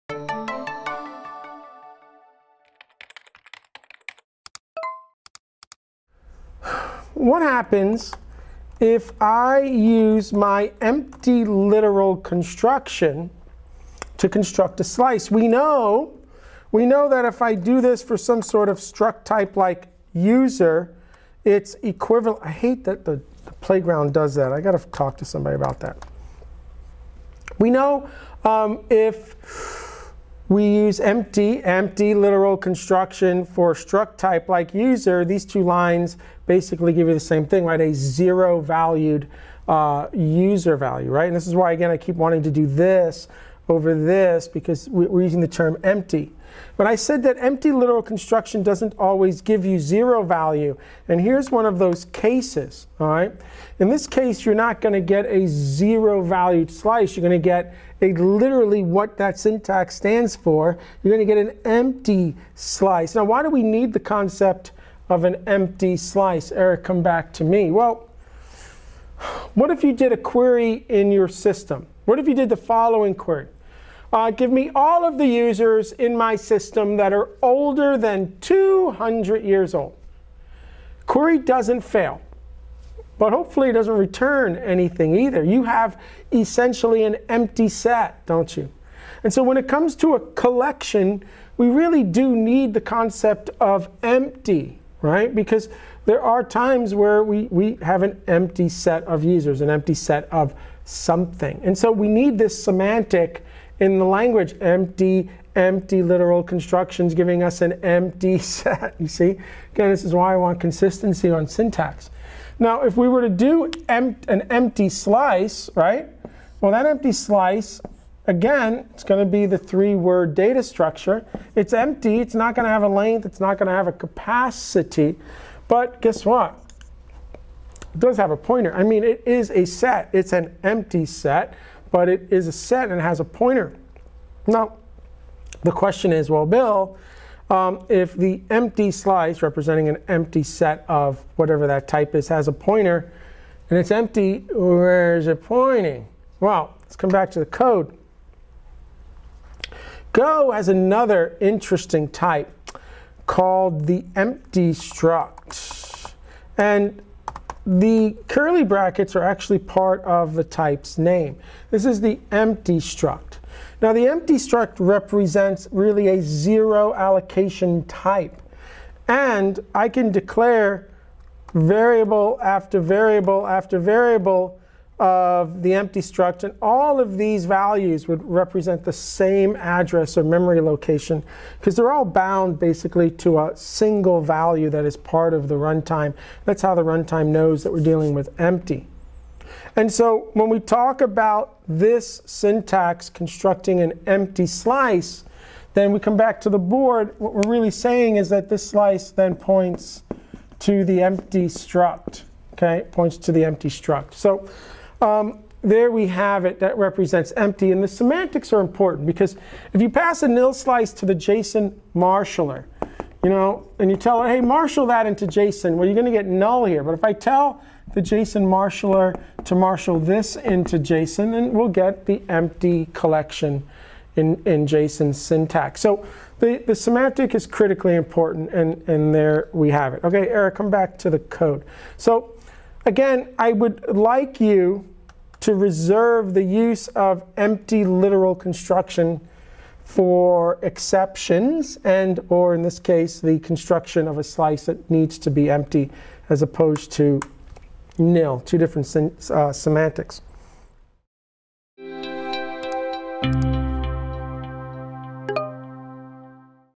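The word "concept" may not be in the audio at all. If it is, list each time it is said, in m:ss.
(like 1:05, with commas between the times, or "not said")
1:03, 1:32.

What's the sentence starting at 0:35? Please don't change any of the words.
These two lines basically give you the same thing, right?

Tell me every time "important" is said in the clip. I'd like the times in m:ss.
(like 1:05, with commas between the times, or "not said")
3:28, 3:47.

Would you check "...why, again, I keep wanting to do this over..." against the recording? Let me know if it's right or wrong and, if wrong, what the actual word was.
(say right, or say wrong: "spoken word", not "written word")
right.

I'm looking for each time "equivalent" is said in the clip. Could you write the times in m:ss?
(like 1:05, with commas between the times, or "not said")
0:21.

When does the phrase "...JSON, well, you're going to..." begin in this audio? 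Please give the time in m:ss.
3:35.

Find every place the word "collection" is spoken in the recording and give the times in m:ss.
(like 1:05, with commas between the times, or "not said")
1:30, 3:42.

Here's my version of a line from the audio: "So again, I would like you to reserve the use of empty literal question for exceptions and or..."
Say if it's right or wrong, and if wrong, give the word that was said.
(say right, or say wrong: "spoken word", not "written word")
wrong: "construction", not "question".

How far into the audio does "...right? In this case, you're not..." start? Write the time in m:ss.
0:53.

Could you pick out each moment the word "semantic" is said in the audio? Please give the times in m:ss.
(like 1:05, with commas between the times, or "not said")
1:42, 3:27, 3:46, 4:09.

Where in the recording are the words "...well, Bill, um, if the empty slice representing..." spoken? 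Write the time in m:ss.
2:16.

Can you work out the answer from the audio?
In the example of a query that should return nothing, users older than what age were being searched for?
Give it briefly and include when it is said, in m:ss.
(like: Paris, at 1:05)
200 years, at 1:18.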